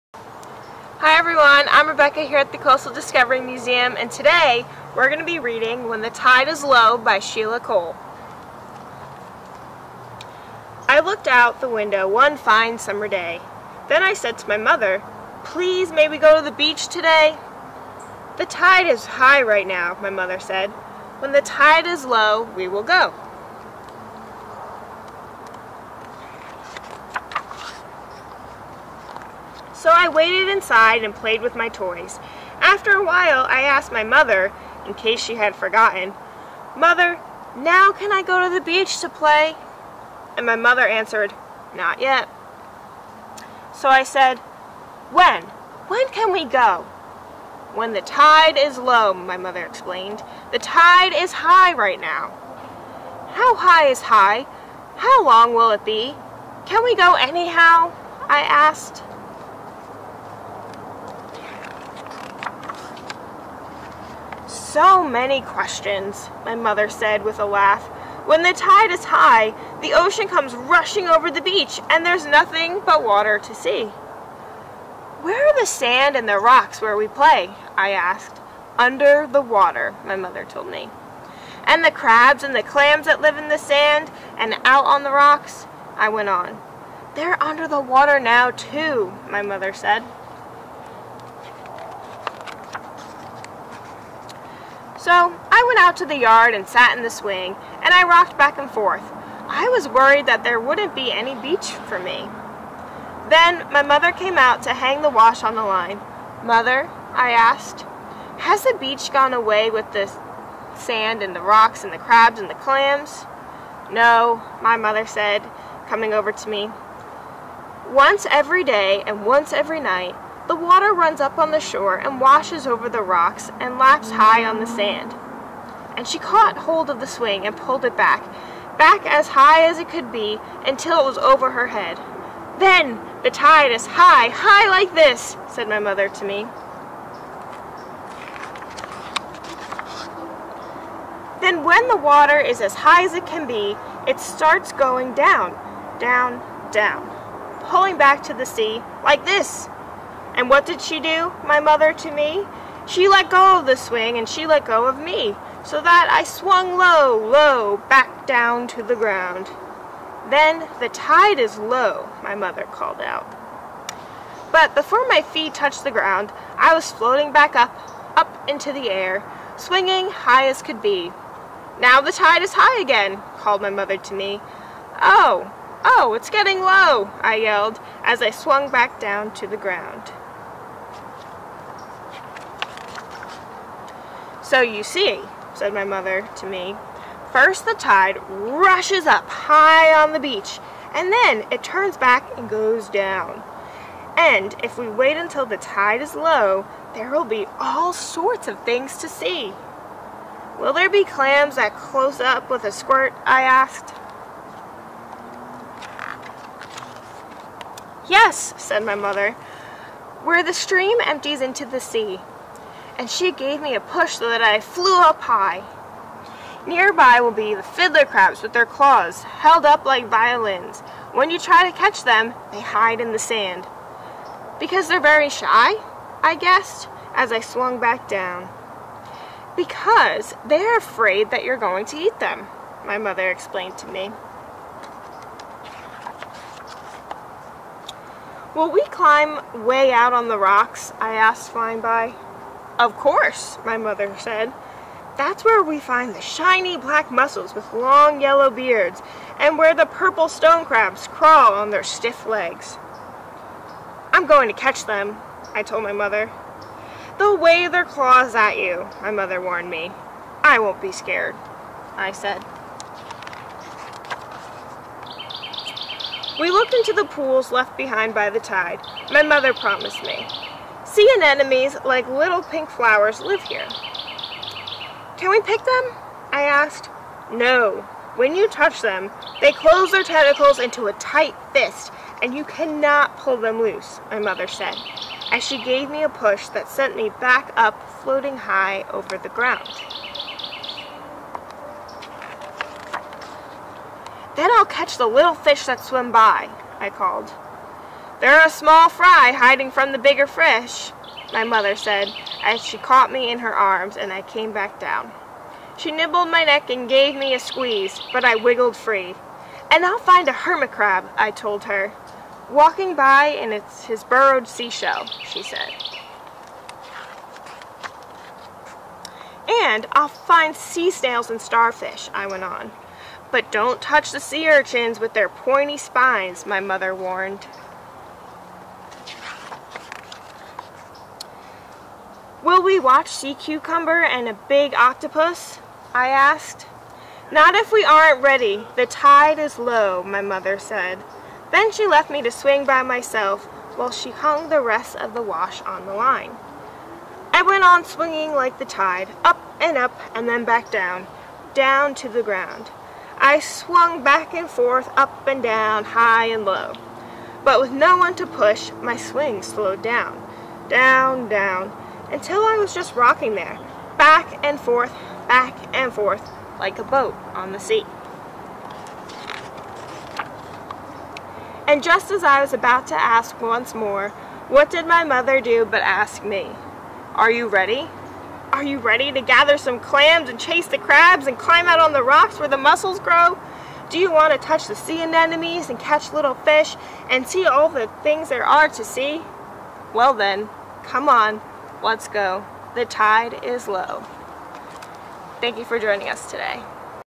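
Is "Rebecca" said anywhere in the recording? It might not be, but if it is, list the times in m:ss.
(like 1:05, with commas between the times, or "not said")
0:01.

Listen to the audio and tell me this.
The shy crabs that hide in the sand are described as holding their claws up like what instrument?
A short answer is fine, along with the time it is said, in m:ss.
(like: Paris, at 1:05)
Violins, at 3:40.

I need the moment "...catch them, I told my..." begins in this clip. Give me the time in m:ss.
4:14.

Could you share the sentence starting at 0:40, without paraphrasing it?
And my mother answered, Not yet.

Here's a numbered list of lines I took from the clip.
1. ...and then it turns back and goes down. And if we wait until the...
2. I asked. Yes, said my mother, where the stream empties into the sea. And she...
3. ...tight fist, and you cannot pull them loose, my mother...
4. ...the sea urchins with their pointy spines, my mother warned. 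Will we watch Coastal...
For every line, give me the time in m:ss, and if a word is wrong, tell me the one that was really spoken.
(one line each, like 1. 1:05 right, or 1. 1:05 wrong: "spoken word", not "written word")
1. 3:10 right
2. 3:23 right
3. 4:40 right
4. 5:24 wrong: "Sea", not "Coastal".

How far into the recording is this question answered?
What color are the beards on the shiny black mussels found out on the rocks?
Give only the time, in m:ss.
4:08.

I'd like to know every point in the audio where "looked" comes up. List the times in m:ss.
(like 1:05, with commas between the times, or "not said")
0:11, 4:26.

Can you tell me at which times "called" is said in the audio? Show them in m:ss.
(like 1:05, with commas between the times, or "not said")
2:42, 2:53, 4:56.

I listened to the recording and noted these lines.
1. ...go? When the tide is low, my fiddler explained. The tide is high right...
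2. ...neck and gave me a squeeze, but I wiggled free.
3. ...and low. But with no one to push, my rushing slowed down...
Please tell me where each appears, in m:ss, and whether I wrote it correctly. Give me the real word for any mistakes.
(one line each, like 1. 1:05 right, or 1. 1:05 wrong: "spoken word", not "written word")
1. 0:46 wrong: "mother", not "fiddler"
2. 5:06 right
3. 5:56 wrong: "swing", not "rushing".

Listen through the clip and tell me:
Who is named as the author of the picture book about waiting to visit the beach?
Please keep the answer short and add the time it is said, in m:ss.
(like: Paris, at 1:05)
Sheila Cole, at 0:07.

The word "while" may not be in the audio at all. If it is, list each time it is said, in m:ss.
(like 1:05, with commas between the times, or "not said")
0:33, 5:43.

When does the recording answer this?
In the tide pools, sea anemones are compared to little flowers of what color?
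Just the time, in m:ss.
4:32.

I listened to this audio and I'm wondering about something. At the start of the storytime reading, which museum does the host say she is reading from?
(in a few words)
Coastal Discovery Museum.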